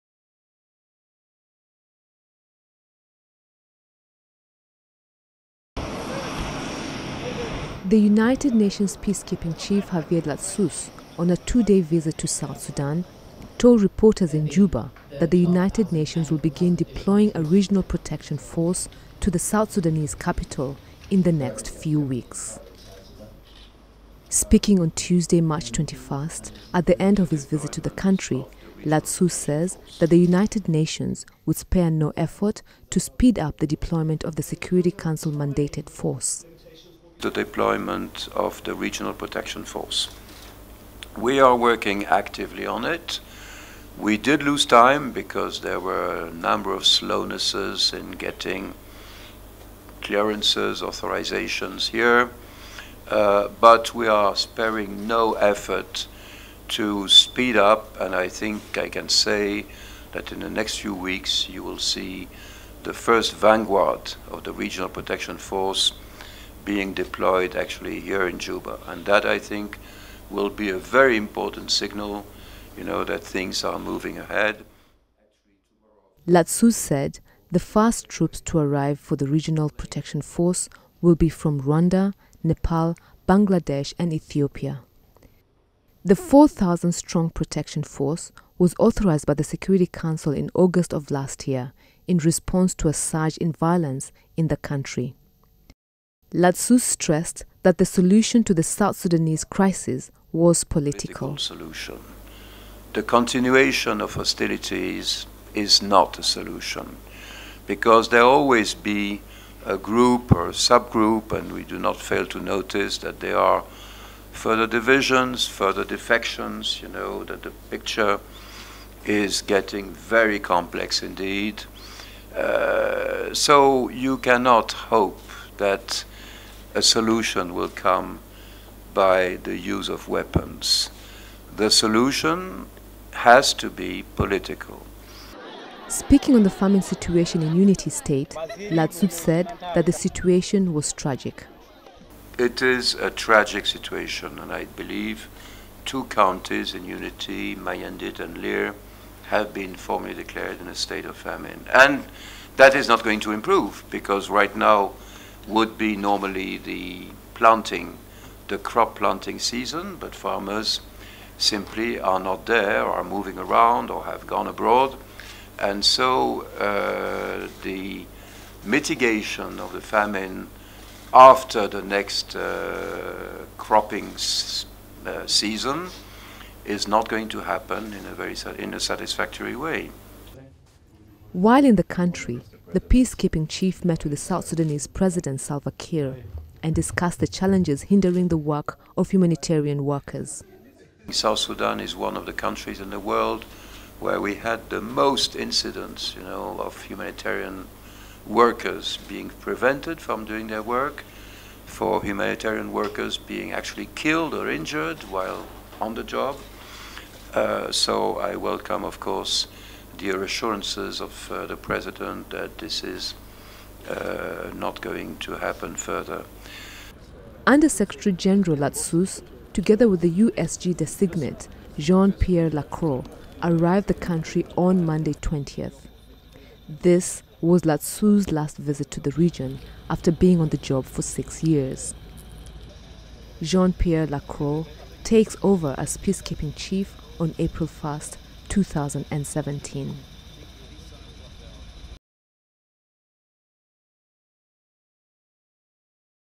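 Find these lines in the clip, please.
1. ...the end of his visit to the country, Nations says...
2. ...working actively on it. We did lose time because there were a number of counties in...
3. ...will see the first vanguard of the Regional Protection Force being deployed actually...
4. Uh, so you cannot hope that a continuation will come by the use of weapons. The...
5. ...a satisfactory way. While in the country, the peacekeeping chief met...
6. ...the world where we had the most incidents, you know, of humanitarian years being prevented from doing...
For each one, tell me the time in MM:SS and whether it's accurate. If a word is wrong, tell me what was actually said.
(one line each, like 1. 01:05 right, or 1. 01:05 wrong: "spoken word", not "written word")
1. 00:26 wrong: "Ladsous", not "Nations"
2. 00:41 wrong: "slownesses", not "counties"
3. 01:01 right
4. 02:02 wrong: "solution", not "continuation"
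5. 02:58 right
6. 03:12 wrong: "workers", not "years".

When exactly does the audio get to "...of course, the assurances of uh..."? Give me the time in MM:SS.
03:28.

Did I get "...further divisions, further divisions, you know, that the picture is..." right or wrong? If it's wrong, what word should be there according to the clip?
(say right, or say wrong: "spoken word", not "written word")
wrong: "defections", not "divisions".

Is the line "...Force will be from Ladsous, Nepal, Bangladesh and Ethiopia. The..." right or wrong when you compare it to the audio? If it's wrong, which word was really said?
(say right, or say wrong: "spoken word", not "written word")
wrong: "Rwanda", not "Ladsous".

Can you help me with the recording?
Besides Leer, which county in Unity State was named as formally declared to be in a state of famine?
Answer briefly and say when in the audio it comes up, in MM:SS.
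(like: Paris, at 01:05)
Mayandit, at 02:27.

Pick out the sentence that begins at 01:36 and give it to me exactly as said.
Ladsous stressed that the solution to the South Sudanese crisis was political.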